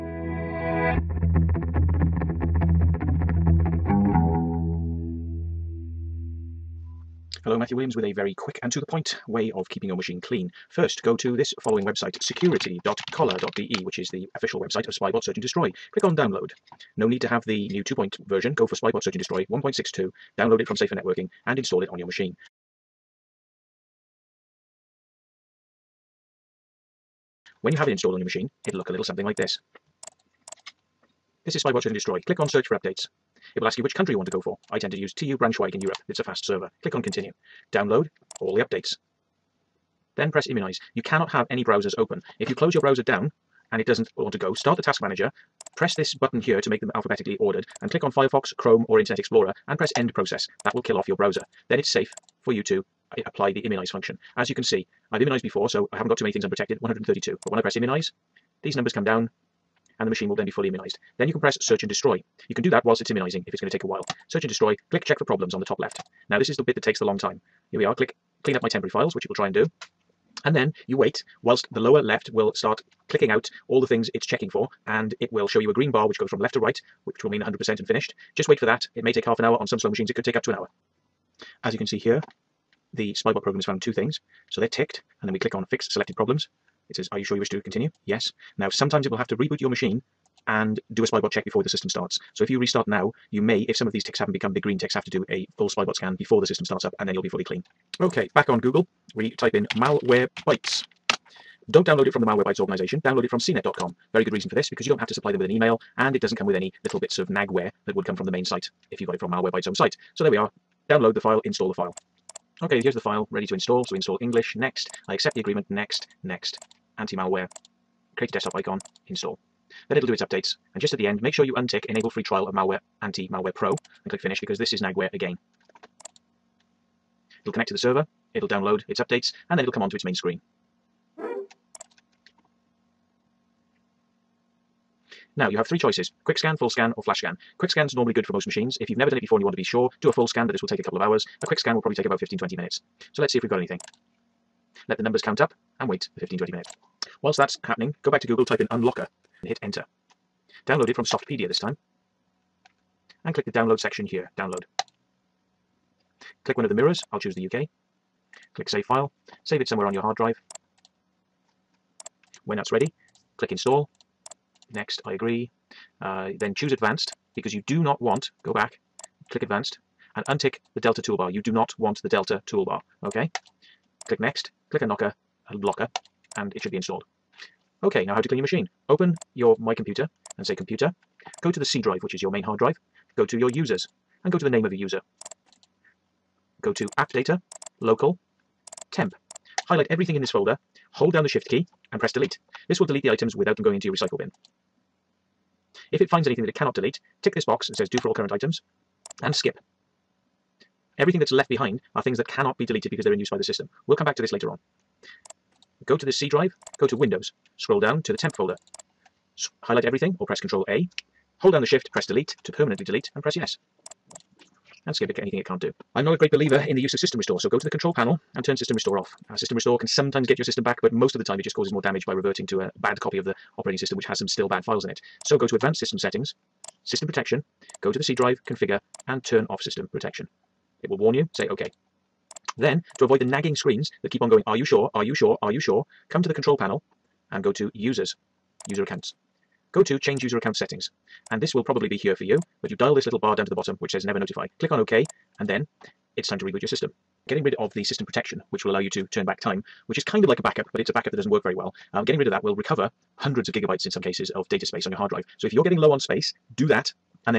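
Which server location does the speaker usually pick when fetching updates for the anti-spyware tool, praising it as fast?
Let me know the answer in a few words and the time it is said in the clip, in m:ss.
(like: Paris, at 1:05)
TU Braunschweig, at 0:35.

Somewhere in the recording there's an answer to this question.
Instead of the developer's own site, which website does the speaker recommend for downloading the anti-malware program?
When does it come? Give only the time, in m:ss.
1:43.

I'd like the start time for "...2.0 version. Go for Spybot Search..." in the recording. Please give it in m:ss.
0:17.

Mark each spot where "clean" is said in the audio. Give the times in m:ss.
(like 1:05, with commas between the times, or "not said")
0:10, 1:08, 1:37, 2:58.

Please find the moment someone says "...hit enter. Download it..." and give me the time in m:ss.
2:29.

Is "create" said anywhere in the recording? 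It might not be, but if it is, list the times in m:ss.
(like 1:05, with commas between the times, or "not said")
1:58.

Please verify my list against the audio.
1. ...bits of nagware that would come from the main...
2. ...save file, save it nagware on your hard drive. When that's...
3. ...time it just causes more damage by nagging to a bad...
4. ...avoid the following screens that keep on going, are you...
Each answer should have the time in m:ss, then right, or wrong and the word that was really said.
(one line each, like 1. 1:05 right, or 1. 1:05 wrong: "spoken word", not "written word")
1. 1:46 right
2. 2:38 wrong: "somewhere", not "nagware"
3. 3:41 wrong: "reverting", not "nagging"
4. 3:53 wrong: "nagging", not "following".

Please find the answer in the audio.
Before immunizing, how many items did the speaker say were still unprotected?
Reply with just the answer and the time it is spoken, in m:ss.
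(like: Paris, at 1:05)
132, at 0:56.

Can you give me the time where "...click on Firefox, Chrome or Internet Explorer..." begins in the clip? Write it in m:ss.
0:47.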